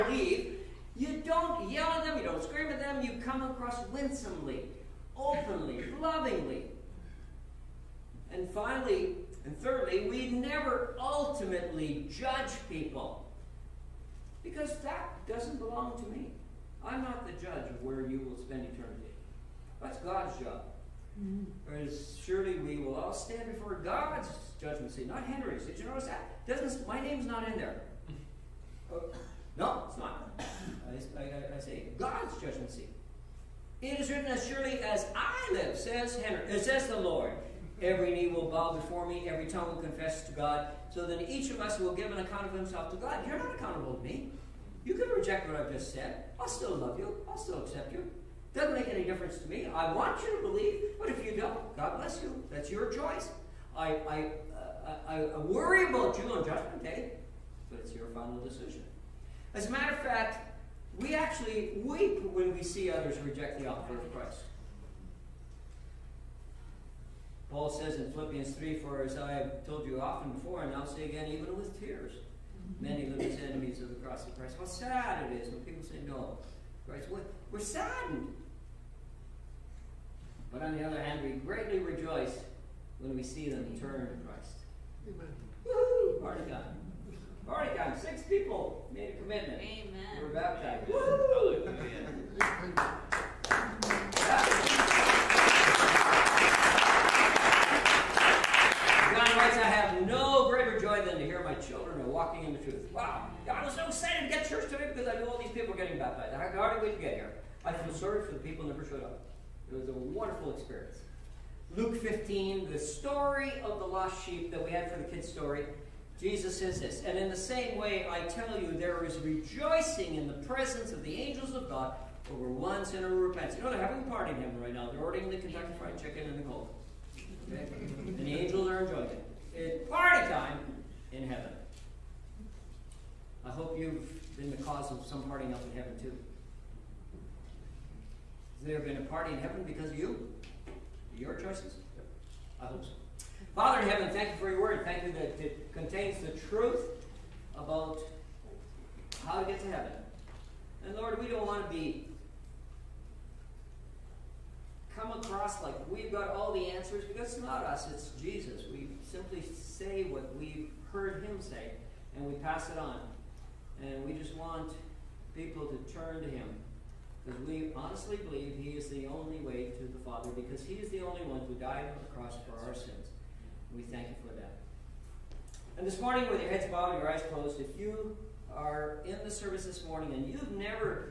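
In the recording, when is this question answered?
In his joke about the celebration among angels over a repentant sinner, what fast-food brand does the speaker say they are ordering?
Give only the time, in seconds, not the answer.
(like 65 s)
125 s.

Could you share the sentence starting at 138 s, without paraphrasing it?
Has there been a party in heaven because of you?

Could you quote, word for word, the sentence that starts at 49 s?
I want you to believe, but if you don't, God bless you.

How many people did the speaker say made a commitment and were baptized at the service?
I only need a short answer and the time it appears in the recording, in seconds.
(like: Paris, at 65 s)
6, at 87 s.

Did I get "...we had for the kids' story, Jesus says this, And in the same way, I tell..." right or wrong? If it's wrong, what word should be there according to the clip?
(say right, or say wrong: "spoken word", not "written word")
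right.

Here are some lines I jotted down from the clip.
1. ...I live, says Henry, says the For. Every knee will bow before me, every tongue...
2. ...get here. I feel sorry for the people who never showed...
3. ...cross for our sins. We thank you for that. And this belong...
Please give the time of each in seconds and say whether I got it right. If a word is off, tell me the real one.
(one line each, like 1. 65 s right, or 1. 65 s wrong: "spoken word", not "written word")
1. 35 s wrong: "Lord", not "For"
2. 107 s right
3. 172 s wrong: "morning", not "belong".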